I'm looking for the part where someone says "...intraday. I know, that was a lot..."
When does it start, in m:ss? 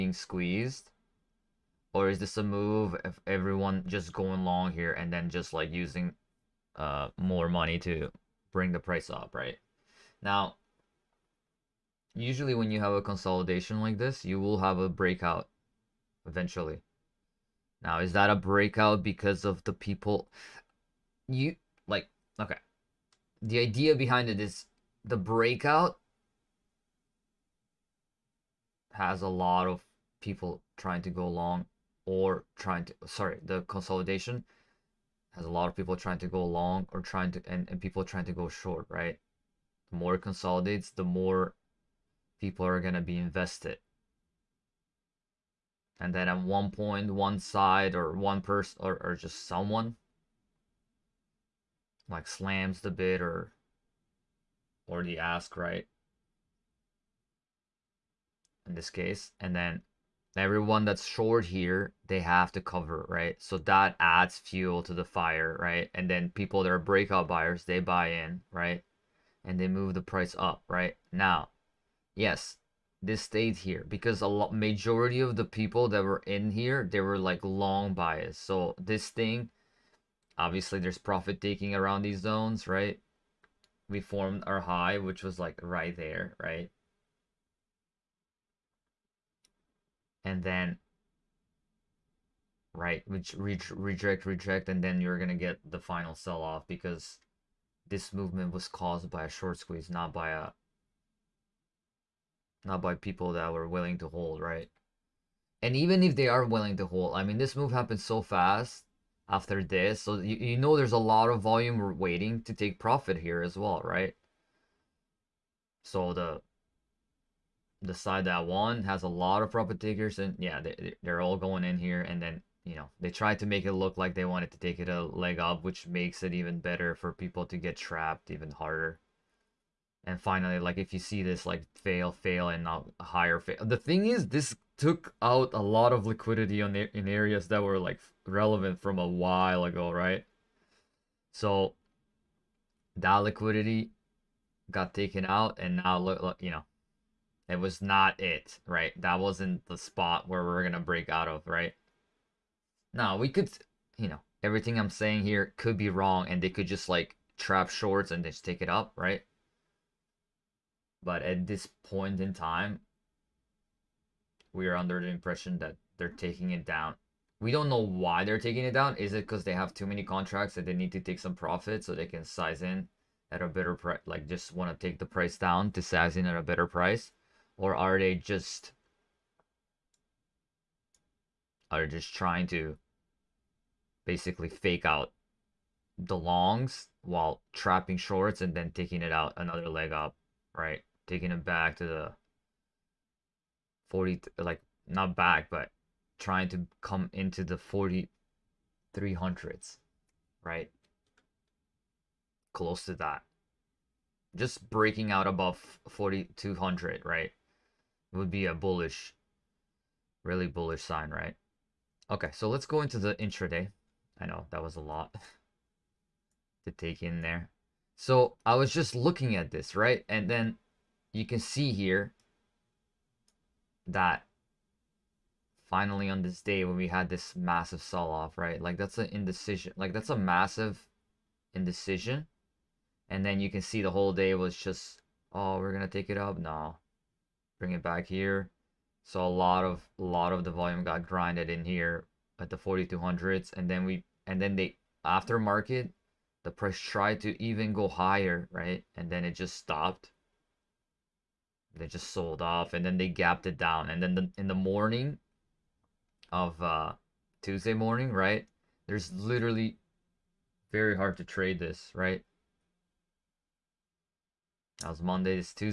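3:33.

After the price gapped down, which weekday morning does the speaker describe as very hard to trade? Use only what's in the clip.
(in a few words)
Tuesday.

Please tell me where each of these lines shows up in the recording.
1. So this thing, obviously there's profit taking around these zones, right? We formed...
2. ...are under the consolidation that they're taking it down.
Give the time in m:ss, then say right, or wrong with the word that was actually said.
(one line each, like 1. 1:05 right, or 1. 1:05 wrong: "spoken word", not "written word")
1. 1:18 right
2. 2:44 wrong: "impression", not "consolidation".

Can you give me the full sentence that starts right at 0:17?
Now, is that a breakout because of the people you like?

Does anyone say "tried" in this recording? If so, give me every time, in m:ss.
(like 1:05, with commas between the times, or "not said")
2:03, 4:06.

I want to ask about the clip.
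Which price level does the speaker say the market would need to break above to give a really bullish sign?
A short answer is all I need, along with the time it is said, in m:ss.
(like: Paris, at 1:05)
4,200, at 3:25.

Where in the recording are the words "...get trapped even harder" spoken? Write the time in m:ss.
2:07.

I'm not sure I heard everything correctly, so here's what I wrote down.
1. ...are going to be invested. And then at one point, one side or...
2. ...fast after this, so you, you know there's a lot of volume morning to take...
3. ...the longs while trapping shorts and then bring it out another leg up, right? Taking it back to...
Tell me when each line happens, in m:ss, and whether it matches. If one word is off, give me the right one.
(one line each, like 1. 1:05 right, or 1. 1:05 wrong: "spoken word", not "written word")
1. 0:42 right
2. 1:48 wrong: "waiting", not "morning"
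3. 3:05 wrong: "taking", not "bring".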